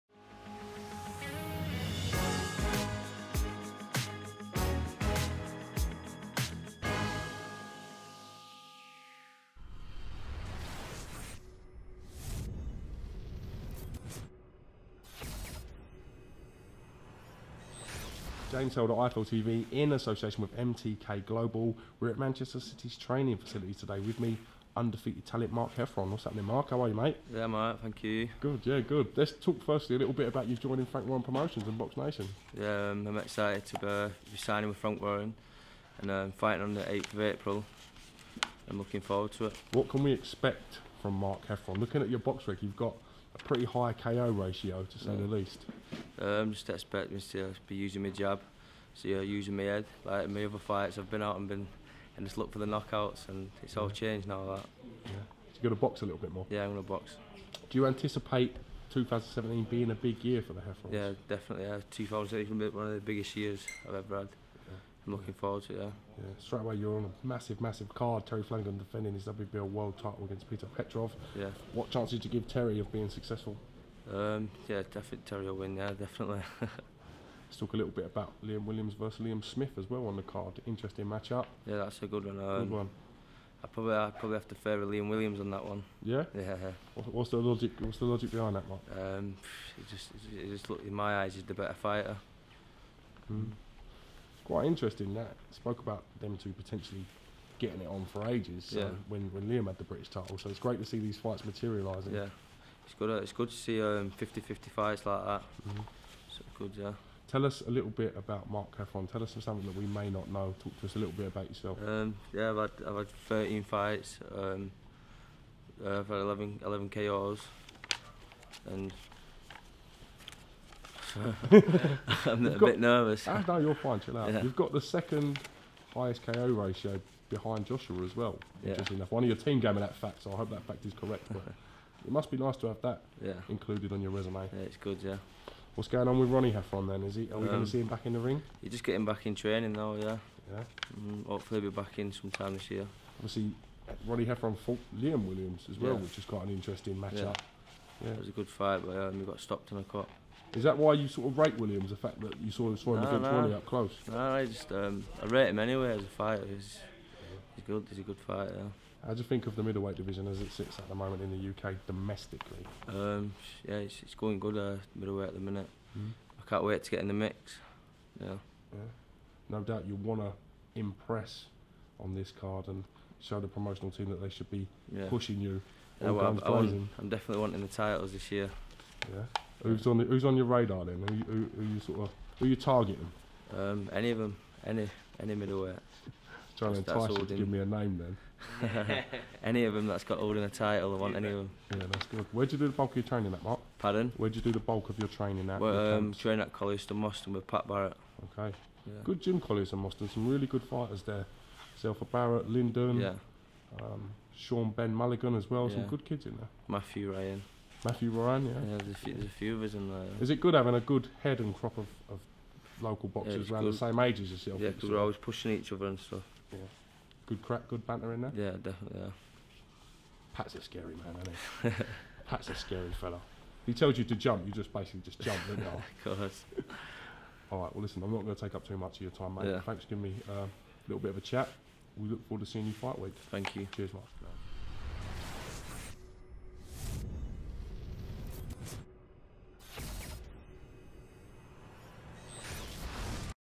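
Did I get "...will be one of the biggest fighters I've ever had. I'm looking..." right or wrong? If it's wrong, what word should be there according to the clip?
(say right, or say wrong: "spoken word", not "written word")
wrong: "years", not "fighters".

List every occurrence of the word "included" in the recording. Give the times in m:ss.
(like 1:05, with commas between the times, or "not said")
2:13.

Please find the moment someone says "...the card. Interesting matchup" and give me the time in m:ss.
1:20.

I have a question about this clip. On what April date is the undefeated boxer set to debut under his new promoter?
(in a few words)
8th of April.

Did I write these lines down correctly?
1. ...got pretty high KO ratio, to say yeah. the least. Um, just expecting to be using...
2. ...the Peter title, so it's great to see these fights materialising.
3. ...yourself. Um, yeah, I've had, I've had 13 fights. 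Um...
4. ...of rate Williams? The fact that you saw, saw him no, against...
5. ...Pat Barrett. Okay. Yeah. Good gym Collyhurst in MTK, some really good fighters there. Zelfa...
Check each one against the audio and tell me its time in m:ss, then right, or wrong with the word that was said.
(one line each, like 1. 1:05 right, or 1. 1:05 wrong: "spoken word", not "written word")
1. 0:42 right
2. 1:39 wrong: "British", not "Peter"
3. 1:51 right
4. 2:31 right
5. 3:17 wrong: "Moston", not "MTK".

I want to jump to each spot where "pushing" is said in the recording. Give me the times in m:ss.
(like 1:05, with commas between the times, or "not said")
2:55, 3:35.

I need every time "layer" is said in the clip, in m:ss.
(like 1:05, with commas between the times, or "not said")
not said.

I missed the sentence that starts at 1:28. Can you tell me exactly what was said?
Um, it just it just look in my eyes, he's the better fighter.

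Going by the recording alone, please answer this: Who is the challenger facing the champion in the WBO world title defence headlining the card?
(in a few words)
Peter Petrov.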